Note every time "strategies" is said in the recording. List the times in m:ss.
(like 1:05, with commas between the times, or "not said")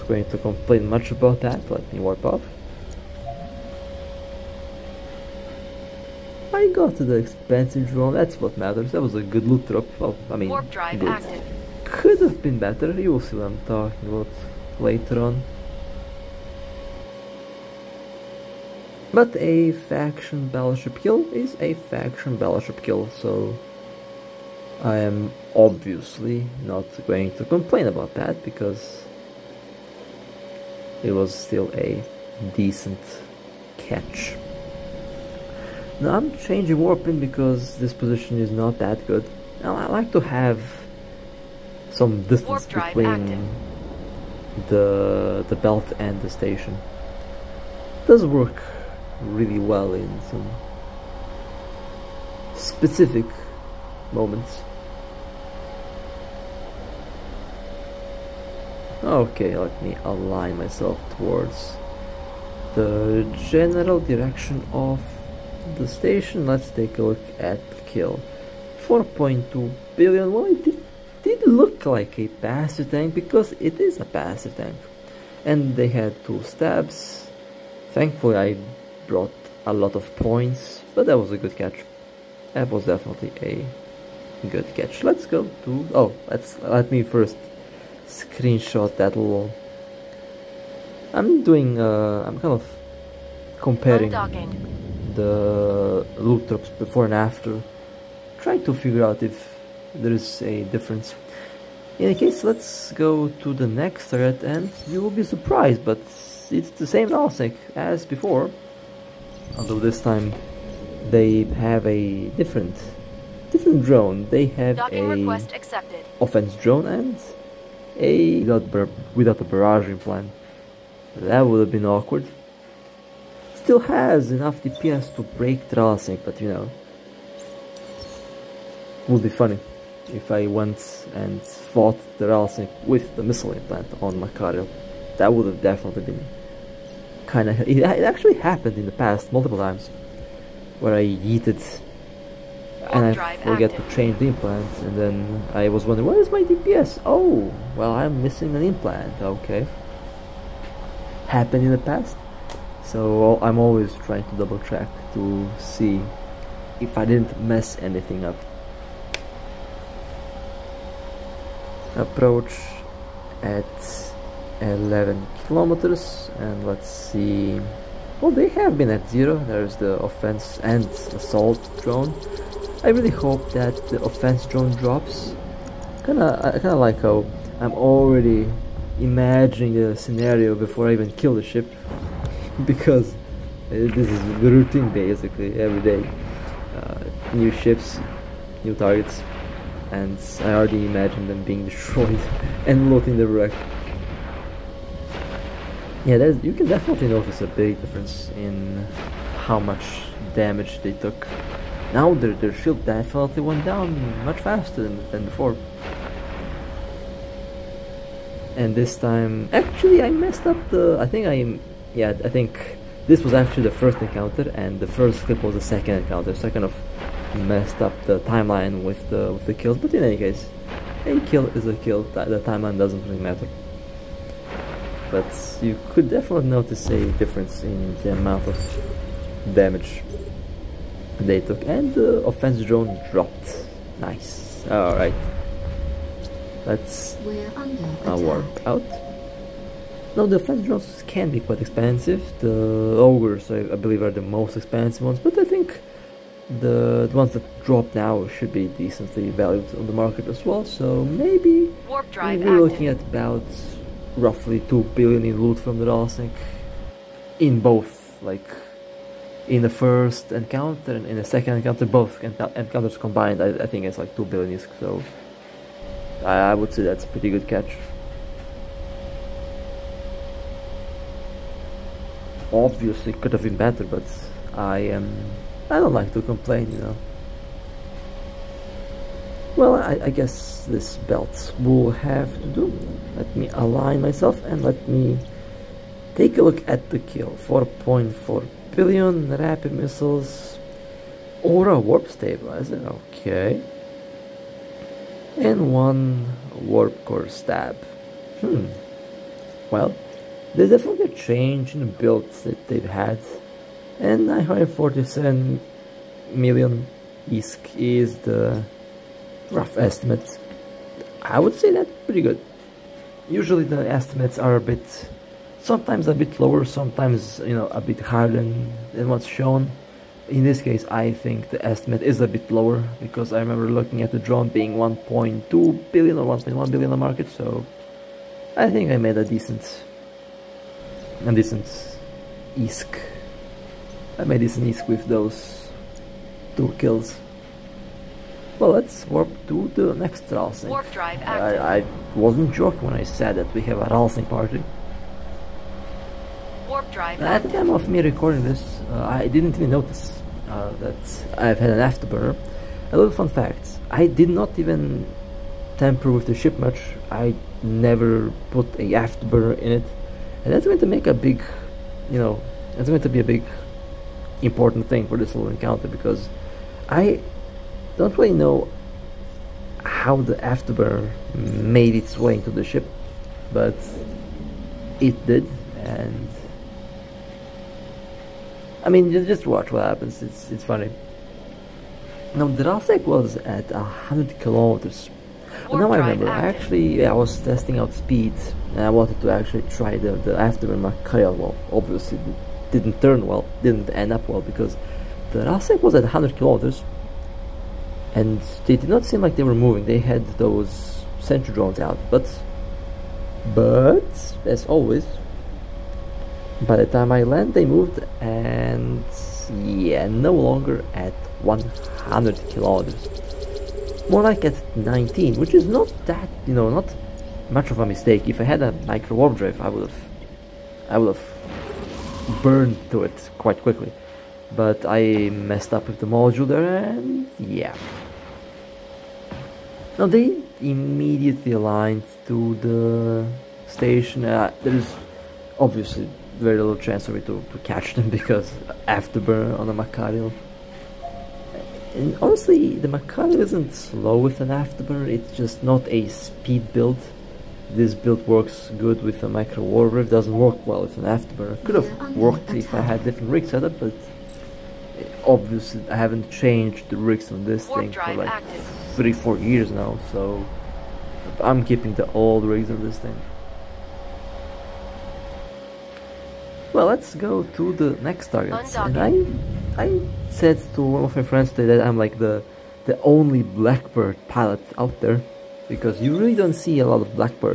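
not said.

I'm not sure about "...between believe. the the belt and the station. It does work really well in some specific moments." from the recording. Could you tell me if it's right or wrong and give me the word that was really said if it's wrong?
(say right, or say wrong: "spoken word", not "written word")
wrong: "active", not "believe".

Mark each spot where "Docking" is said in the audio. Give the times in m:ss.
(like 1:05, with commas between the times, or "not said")
1:54.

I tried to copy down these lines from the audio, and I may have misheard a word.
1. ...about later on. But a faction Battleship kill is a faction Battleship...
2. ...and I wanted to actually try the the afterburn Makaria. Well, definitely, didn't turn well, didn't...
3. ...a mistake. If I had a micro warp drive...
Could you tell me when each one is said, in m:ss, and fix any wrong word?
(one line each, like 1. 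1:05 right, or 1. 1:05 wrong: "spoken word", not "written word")
1. 0:14 right
2. 6:28 wrong: "obviously", not "definitely"
3. 6:57 right.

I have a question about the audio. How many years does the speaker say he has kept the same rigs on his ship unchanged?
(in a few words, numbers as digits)
3 to 4 years.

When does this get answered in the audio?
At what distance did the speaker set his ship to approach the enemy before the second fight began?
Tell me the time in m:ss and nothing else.
2:44.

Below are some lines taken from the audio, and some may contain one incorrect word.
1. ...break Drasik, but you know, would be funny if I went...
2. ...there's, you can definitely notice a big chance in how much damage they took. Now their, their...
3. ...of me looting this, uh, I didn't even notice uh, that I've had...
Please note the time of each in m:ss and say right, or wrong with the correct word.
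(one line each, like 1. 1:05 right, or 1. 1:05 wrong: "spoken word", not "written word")
1. 2:05 right
2. 3:16 wrong: "difference", not "chance"
3. 5:47 wrong: "recording", not "looting".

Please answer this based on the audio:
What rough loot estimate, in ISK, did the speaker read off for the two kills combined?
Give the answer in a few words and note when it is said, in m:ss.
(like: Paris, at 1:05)
947 million, at 5:04.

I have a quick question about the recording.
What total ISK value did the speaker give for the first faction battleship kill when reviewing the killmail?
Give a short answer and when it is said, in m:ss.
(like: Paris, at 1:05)
4.2 billion, at 1:08.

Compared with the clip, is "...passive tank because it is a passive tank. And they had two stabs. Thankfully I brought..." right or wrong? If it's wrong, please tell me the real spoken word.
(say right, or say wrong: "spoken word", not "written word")
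right.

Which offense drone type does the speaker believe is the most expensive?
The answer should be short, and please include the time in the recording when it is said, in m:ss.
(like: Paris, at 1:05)
Ogres, at 4:03.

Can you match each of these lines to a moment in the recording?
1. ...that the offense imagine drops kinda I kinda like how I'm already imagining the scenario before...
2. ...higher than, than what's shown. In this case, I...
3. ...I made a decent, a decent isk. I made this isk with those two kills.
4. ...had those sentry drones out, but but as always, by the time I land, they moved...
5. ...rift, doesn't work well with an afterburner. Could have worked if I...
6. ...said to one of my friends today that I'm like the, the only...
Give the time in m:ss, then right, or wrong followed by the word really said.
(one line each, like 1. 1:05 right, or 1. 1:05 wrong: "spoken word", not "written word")
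1. 2:53 wrong: "drone", not "imagine"
2. 5:18 right
3. 5:28 right
4. 6:39 right
5. 7:29 right
6. 7:50 right.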